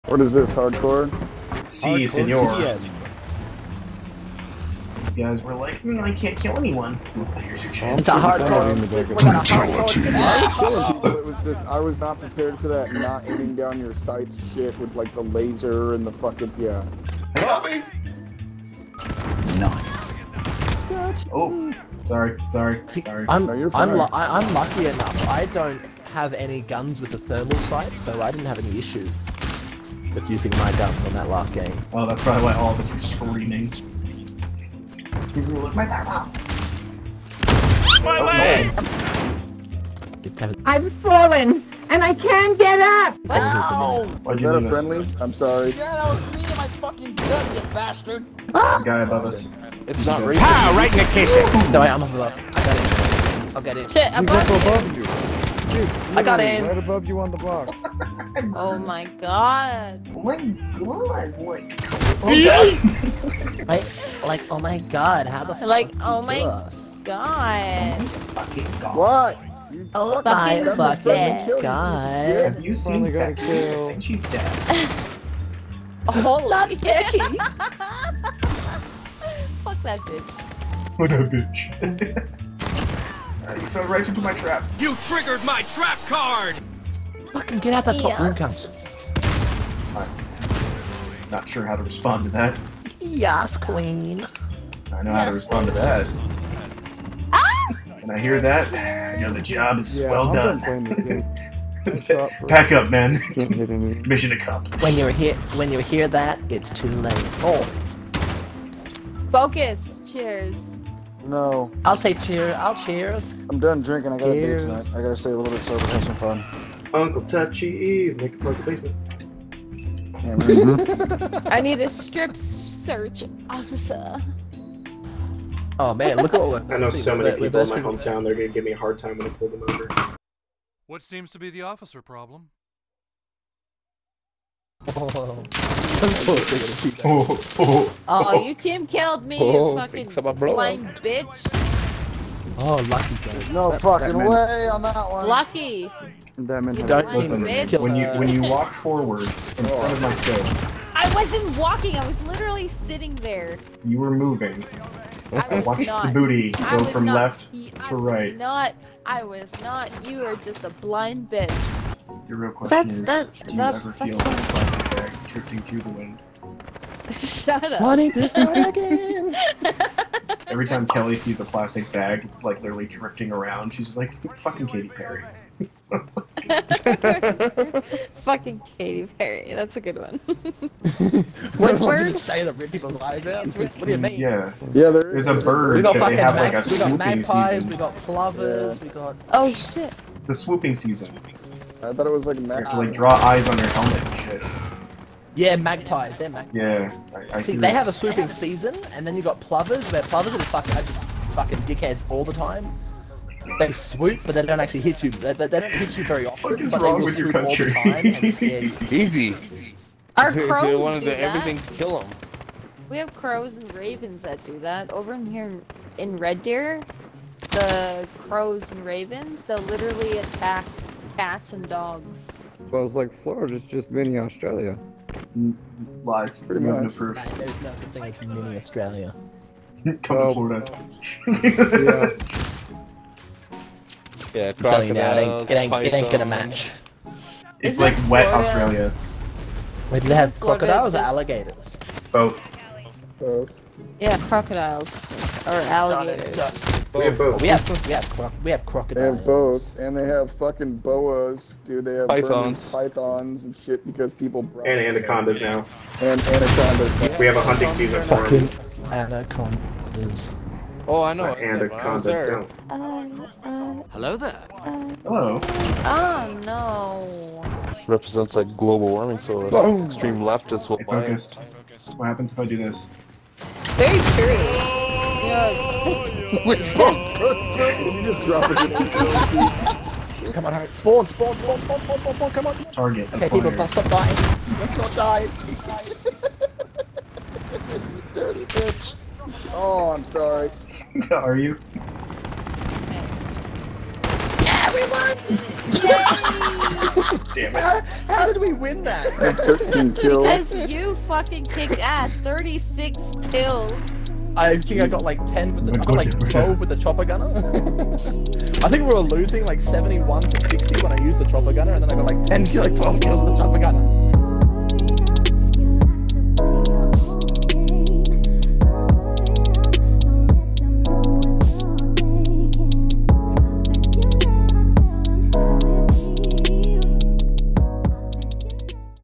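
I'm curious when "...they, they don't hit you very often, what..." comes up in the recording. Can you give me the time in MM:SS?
03:25.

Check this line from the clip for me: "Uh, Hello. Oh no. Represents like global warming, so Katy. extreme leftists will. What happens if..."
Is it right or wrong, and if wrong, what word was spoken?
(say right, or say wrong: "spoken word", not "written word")
wrong: "Boom", not "Katy".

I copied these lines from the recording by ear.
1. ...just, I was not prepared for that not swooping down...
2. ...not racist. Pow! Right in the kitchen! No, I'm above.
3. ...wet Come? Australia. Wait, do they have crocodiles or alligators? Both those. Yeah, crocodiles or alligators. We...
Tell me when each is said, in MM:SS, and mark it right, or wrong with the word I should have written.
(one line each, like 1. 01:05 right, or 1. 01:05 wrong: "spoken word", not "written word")
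1. 00:11 wrong: "aiming", not "swooping"
2. 00:50 right
3. 03:58 wrong: "Florida", not "Come".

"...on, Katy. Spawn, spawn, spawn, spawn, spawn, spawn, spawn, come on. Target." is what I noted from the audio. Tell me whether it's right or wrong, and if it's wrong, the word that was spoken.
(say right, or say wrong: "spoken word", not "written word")
wrong: "Hart", not "Katy".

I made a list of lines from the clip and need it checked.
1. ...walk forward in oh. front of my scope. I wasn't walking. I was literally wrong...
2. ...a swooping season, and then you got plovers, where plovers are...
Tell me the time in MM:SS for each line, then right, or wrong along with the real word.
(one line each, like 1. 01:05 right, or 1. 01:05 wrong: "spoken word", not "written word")
1. 02:28 wrong: "sitting", not "wrong"
2. 03:17 right.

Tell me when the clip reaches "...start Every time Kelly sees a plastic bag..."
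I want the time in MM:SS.
02:48.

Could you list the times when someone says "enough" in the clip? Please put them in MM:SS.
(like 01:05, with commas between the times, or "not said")
00:24.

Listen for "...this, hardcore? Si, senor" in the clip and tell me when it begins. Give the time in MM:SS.
00:00.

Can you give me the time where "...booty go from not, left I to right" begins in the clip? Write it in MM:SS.
02:36.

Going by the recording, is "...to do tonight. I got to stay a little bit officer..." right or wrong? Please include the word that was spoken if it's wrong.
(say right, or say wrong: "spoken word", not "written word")
wrong: "sober", not "officer".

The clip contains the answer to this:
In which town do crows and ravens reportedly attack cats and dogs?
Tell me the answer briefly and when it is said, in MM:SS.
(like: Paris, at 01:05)
Red Deer, at 03:36.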